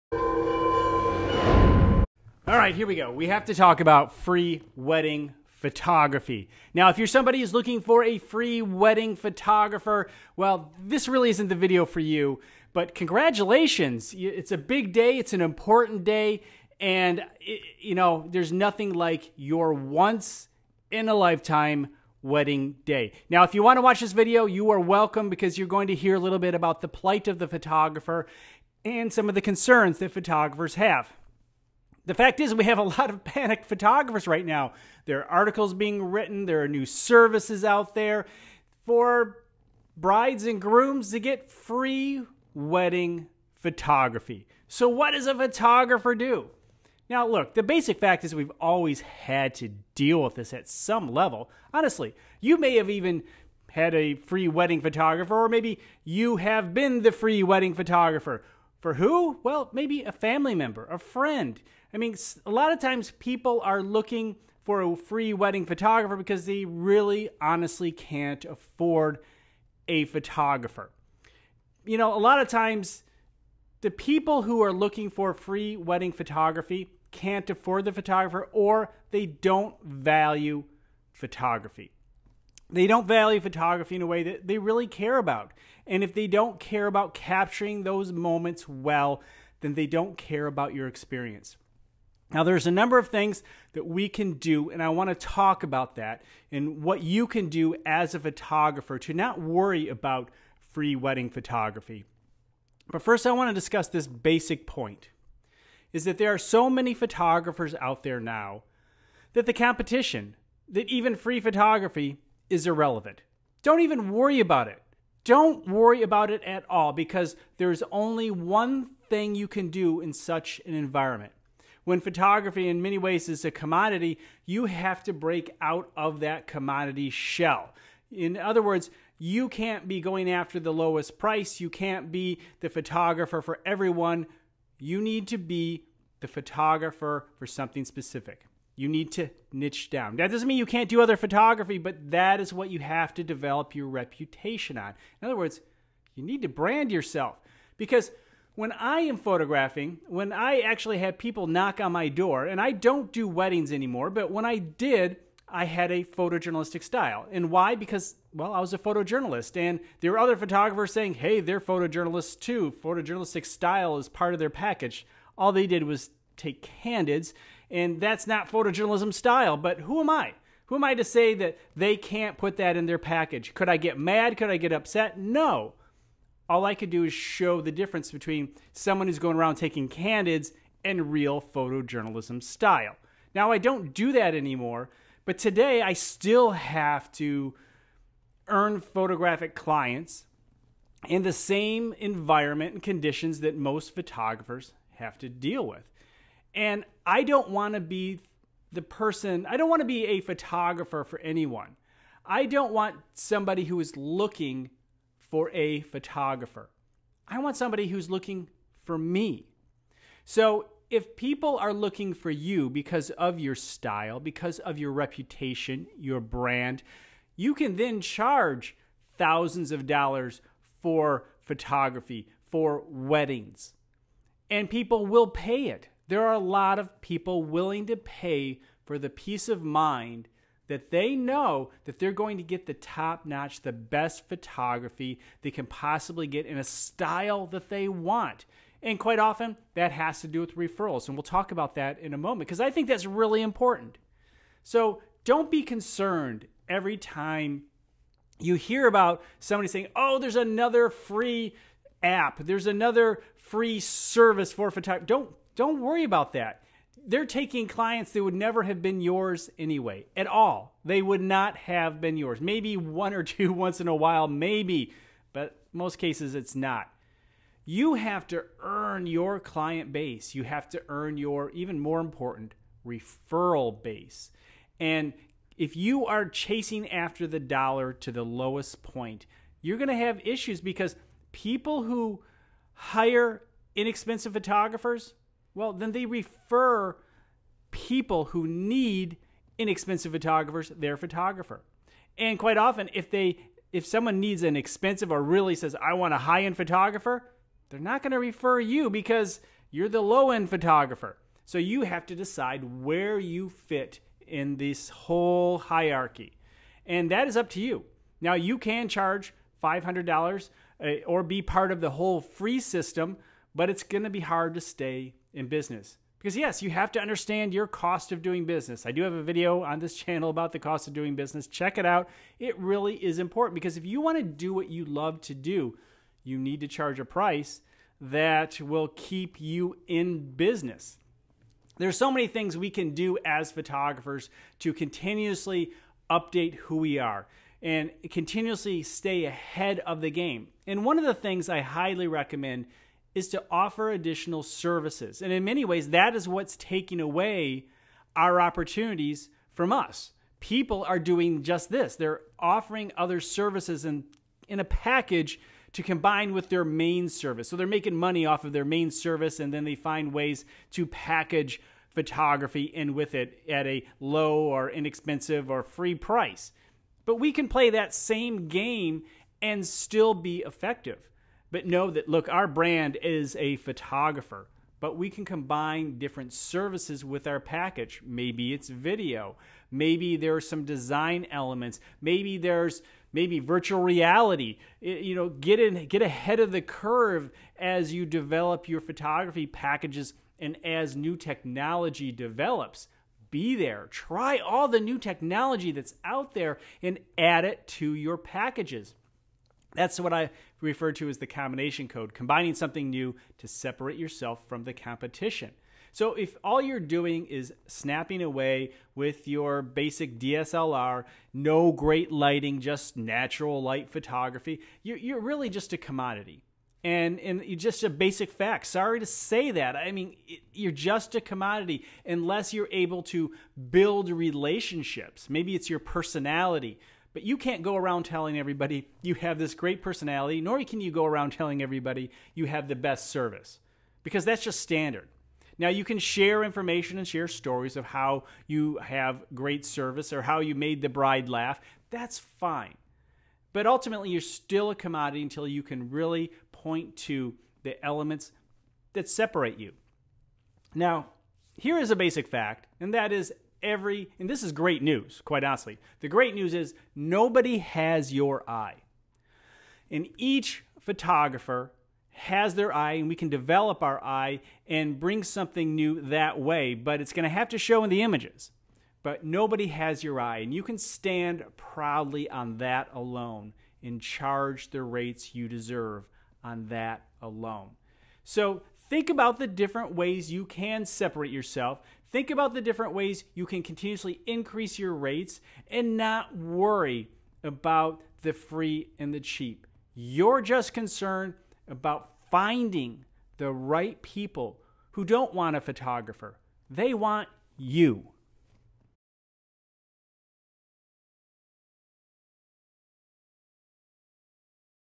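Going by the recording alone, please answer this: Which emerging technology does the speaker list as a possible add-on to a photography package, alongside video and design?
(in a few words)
virtual reality.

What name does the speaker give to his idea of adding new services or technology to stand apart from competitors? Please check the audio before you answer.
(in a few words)
combination code.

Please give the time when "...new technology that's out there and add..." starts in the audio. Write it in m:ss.
6:34.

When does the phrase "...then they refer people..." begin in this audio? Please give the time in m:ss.
4:45.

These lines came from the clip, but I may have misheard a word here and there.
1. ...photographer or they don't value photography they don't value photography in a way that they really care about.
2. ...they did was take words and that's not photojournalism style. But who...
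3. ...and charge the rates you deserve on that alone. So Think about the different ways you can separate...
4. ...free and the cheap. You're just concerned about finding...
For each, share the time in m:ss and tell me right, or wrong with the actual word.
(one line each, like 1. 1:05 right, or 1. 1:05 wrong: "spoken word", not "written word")
1. 1:17 right
2. 2:45 wrong: "candids", not "words"
3. 7:53 right
4. 8:08 right.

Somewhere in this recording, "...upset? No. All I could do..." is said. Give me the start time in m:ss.
2:54.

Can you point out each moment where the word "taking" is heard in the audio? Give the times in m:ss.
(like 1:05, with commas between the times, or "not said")
2:59, 4:17, 5:46.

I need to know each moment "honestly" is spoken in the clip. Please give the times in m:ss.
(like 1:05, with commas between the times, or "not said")
0:51, 1:07, 7:35.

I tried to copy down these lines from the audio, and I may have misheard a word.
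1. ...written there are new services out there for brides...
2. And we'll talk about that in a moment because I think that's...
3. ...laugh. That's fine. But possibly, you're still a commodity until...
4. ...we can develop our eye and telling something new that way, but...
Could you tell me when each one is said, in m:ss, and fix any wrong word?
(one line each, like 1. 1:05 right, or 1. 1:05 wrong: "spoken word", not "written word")
1. 0:36 right
2. 4:01 right
3. 7:21 wrong: "ultimately", not "possibly"
4. 7:43 wrong: "bring", not "telling".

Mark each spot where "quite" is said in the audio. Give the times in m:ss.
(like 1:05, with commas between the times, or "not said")
3:58, 4:52, 7:35.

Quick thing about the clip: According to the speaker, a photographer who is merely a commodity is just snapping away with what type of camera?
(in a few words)
DSLR.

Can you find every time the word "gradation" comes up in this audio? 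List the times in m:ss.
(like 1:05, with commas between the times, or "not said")
not said.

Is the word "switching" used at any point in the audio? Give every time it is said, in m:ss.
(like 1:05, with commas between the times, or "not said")
not said.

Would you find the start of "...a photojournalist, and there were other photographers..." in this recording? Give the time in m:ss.
2:38.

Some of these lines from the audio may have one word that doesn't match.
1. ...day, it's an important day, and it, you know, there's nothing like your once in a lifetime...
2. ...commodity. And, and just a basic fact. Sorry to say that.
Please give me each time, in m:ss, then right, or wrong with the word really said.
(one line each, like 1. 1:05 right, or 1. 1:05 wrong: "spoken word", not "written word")
1. 0:14 right
2. 6:55 right.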